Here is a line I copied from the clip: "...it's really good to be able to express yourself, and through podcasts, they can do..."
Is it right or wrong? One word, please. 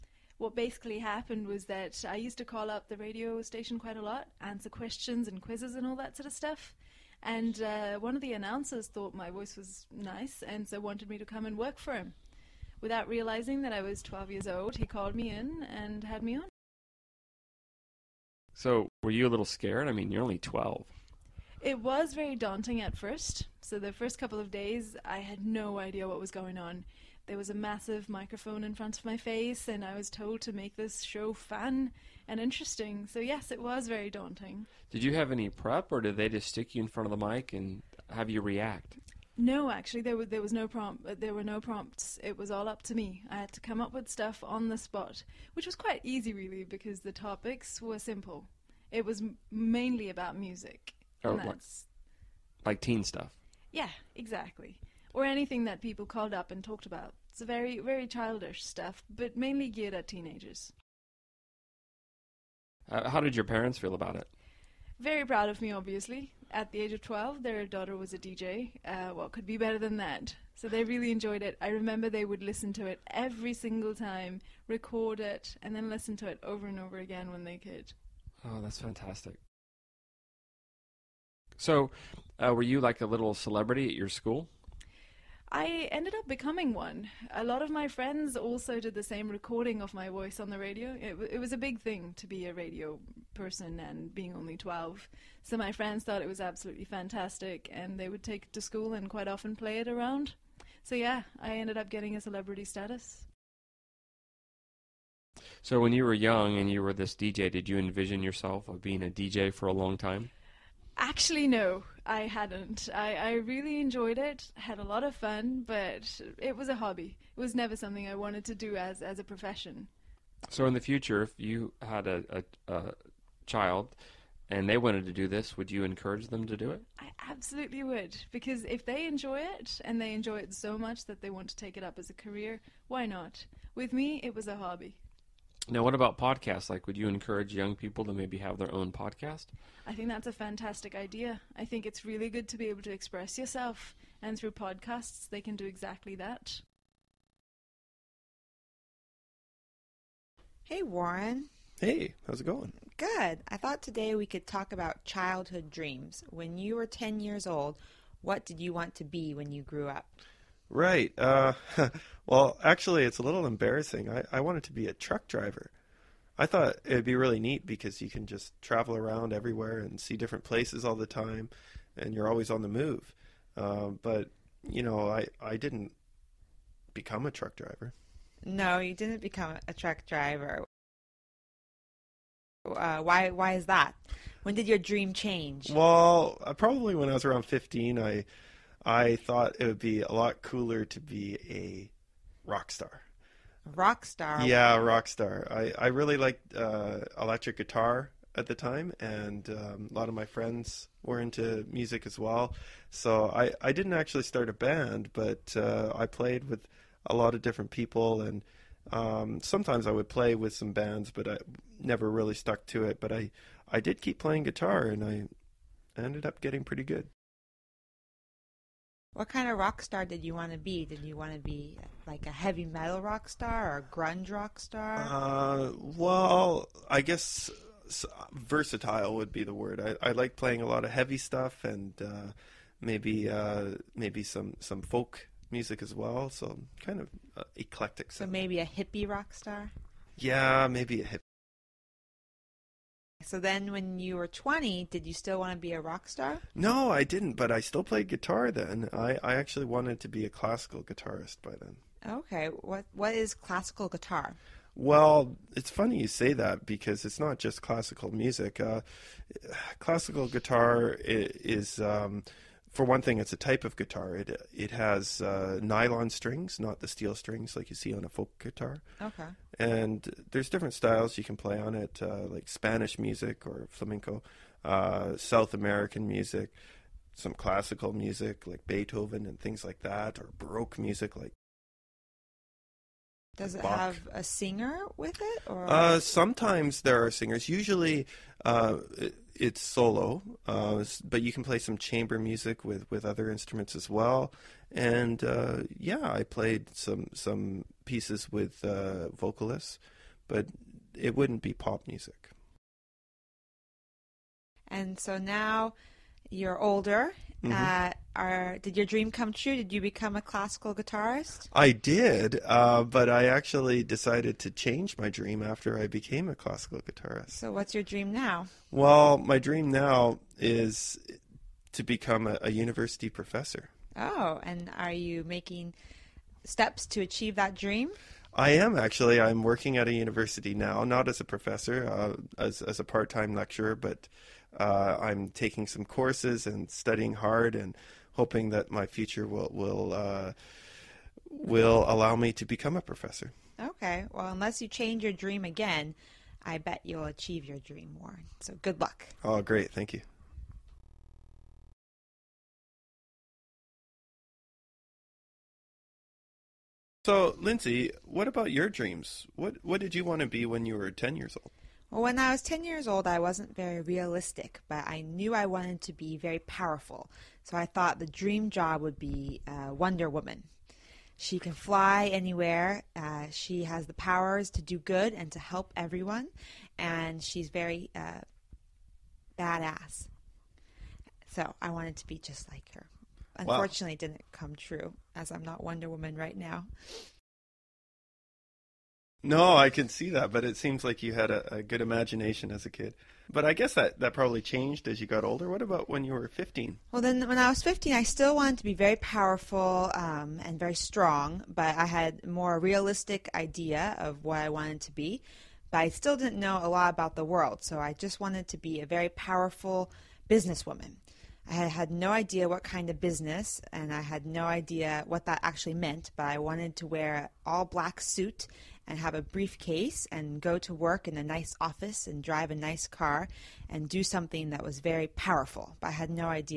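right.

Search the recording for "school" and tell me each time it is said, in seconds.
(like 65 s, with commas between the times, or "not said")
84 s, 98 s.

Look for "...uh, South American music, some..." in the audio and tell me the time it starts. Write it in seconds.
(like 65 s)
274 s.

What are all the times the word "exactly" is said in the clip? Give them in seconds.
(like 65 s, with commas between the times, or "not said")
54 s, 145 s.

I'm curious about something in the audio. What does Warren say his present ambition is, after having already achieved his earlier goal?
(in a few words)
University professor.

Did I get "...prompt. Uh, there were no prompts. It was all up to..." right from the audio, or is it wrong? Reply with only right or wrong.
right.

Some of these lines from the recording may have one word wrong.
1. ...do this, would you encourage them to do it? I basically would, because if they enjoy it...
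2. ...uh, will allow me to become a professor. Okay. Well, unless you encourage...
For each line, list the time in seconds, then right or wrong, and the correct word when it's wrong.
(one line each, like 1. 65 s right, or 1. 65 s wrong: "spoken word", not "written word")
1. 125 s wrong: "absolutely", not "basically"
2. 339 s wrong: "change", not "encourage".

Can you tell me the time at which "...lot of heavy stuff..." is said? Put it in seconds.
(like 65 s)
230 s.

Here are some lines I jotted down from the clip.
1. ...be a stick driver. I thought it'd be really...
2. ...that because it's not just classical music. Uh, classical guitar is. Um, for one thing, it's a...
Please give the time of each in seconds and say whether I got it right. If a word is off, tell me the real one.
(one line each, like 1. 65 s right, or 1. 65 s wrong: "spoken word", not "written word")
1. 164 s wrong: "truck", not "stick"
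2. 256 s right.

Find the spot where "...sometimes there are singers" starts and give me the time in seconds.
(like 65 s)
286 s.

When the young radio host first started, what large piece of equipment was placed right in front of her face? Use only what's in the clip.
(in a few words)
A massive microphone.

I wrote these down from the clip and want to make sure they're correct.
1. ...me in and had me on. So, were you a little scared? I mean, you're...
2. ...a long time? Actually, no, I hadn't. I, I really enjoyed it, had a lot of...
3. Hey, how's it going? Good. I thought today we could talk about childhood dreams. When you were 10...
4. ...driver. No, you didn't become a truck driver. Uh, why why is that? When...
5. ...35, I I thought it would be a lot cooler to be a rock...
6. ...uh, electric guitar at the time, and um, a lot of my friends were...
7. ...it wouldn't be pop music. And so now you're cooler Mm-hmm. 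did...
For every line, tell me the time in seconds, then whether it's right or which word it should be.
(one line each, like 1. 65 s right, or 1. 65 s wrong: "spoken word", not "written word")
1. 15 s right
2. 109 s right
3. 151 s right
4. 177 s right
5. 187 s wrong: "15", not "35"
6. 196 s right
7. 300 s wrong: "older", not "cooler".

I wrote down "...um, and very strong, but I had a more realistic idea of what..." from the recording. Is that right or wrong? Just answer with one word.
right.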